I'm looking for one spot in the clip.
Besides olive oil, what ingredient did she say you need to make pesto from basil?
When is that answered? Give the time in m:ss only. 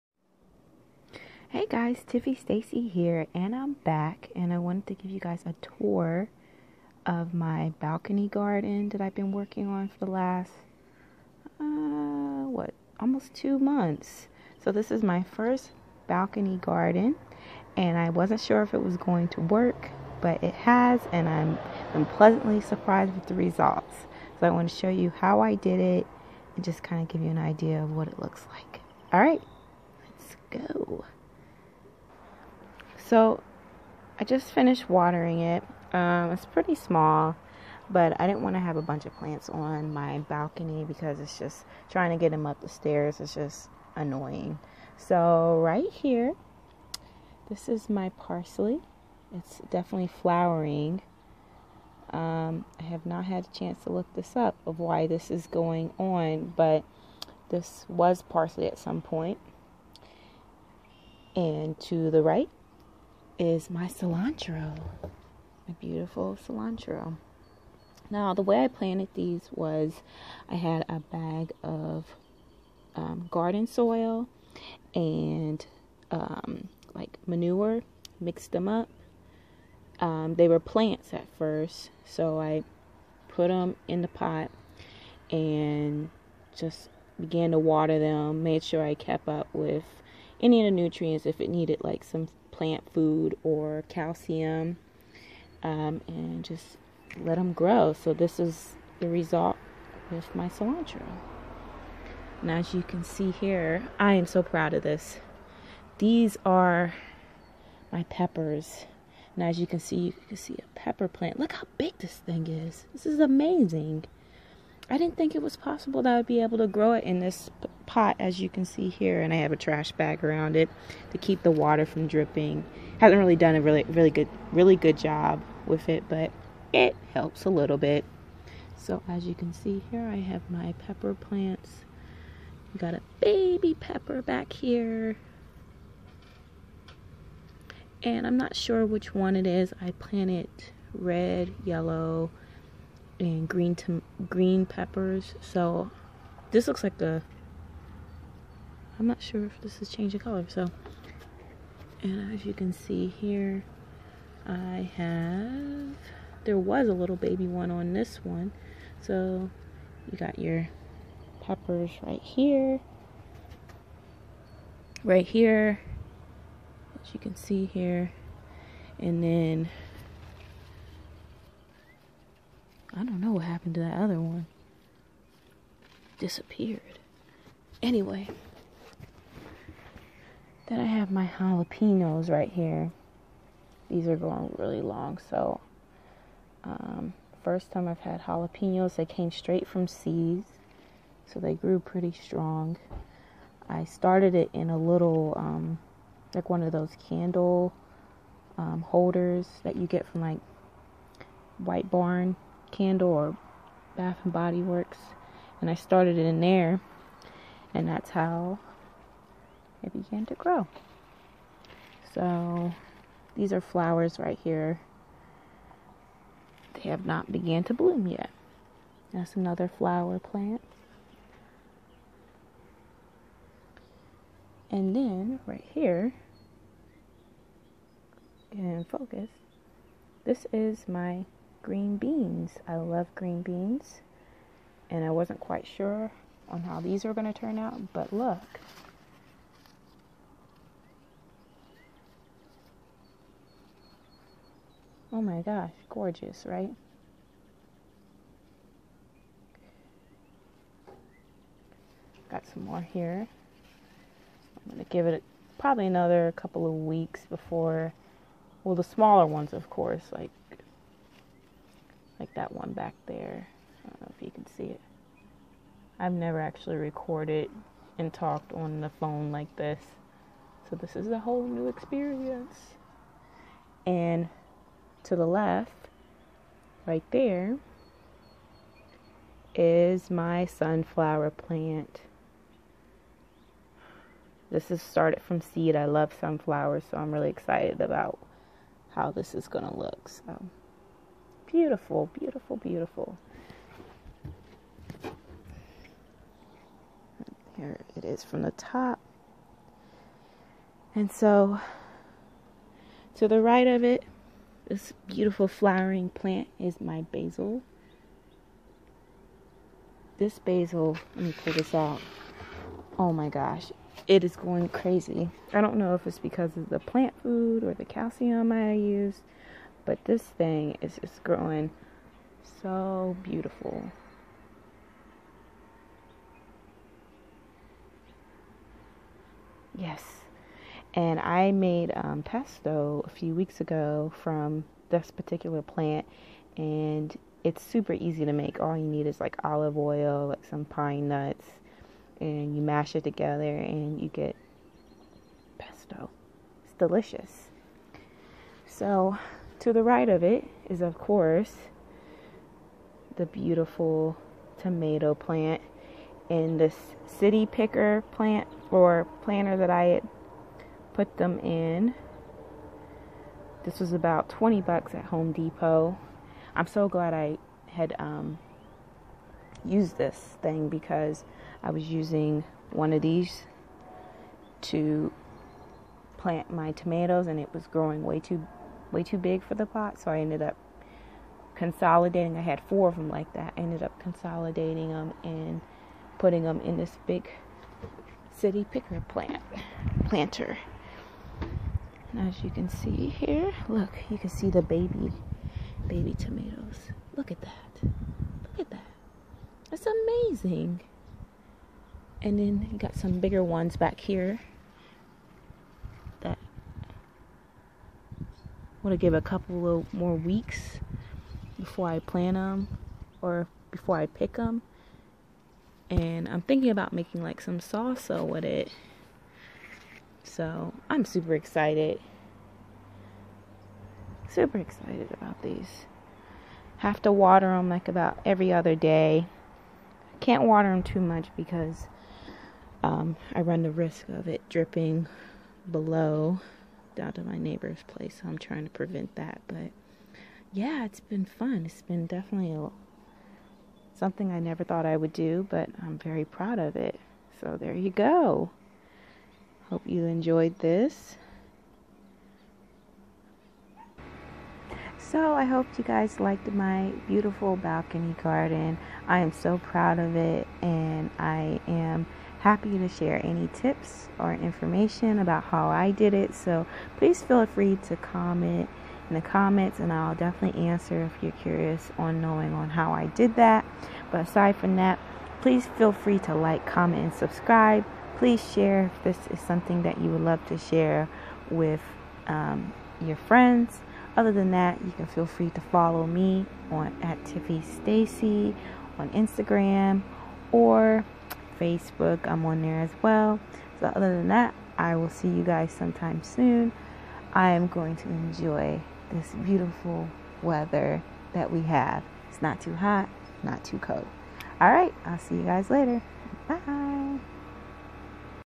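5:40.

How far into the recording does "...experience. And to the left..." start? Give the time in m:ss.
4:31.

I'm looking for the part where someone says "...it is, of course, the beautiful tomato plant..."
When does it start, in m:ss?
5:50.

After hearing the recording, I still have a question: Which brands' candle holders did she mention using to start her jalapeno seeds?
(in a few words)
White Barn Candle or Bath and Body Works.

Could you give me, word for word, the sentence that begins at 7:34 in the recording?
So I hope you guys liked my beautiful balcony garden.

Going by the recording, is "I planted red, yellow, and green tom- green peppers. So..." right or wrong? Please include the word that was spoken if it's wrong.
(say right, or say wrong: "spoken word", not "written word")
right.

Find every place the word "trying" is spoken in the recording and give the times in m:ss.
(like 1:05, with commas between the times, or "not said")
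0:41, 7:18.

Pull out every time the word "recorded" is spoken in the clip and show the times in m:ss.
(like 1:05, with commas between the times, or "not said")
4:26.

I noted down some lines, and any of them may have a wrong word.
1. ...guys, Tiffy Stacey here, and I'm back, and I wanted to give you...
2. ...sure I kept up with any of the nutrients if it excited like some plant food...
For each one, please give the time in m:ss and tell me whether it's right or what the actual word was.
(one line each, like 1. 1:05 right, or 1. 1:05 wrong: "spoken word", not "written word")
1. 0:01 right
2. 1:28 wrong: "needed", not "excited".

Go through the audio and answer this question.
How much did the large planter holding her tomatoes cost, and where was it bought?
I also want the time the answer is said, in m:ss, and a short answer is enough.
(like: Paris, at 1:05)
$20 at Home Depot, at 6:04.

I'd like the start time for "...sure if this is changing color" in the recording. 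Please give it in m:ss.
2:29.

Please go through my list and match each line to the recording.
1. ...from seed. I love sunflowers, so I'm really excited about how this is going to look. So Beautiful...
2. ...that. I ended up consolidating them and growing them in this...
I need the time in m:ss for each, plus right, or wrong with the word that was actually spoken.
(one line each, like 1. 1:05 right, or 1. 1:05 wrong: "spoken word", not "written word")
1. 4:45 right
2. 6:23 wrong: "putting", not "growing".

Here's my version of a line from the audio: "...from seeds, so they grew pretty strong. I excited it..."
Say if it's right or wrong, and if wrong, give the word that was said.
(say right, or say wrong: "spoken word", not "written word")
wrong: "started", not "excited".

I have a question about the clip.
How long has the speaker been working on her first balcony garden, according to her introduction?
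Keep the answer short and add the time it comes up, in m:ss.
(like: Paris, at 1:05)
almost two months, at 0:13.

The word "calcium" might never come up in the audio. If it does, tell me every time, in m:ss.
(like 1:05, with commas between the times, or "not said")
1:33, 5:17.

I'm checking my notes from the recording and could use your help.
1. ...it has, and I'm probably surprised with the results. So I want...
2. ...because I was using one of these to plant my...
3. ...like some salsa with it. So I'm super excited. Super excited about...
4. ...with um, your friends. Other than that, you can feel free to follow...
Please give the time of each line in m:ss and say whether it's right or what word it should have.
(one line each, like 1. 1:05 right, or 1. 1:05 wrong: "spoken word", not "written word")
1. 0:20 wrong: "pleasantly", not "probably"
2. 6:10 right
3. 6:57 right
4. 8:01 right.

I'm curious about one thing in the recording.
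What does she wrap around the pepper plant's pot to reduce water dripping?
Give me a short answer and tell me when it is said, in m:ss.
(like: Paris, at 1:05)
trash bag, at 1:59.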